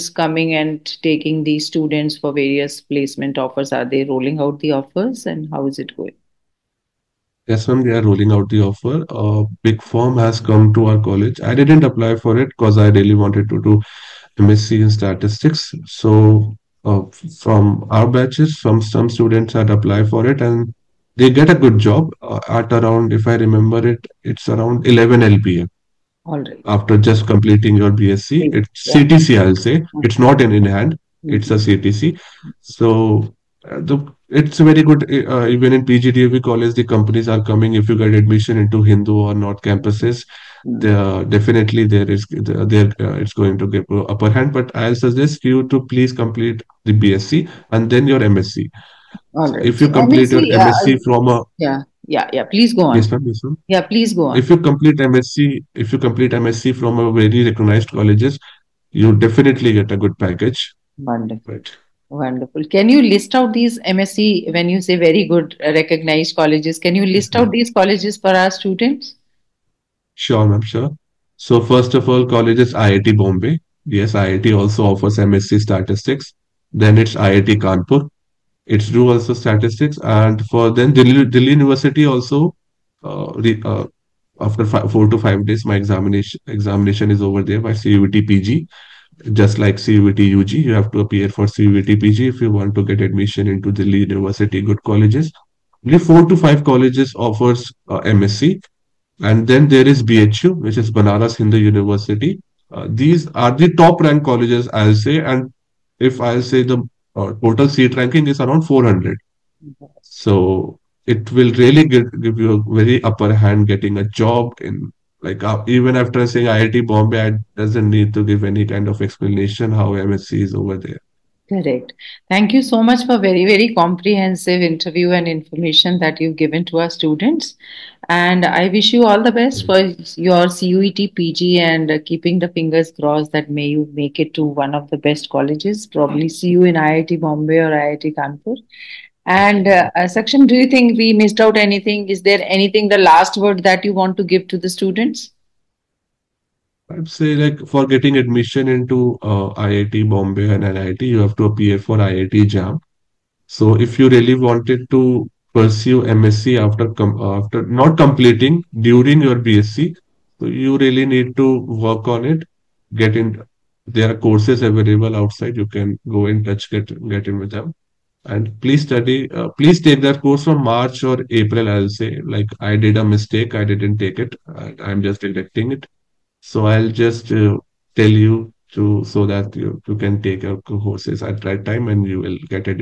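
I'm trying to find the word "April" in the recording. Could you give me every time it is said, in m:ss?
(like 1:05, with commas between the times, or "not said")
2:51.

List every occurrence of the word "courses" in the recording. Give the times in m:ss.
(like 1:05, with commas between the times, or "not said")
2:44, 2:50, 3:00.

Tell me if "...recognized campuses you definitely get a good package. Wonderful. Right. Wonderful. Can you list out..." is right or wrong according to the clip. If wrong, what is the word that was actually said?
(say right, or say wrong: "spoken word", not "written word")
wrong: "colleges", not "campuses".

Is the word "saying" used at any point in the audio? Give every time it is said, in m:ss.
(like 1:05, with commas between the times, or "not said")
1:56.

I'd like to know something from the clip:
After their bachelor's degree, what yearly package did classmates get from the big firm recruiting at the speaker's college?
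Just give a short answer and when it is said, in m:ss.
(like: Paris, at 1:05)
11 LPA, at 0:24.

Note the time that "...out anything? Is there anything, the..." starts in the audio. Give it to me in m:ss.
2:21.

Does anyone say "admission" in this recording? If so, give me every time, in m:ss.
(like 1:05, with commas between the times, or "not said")
0:38, 1:33, 2:28.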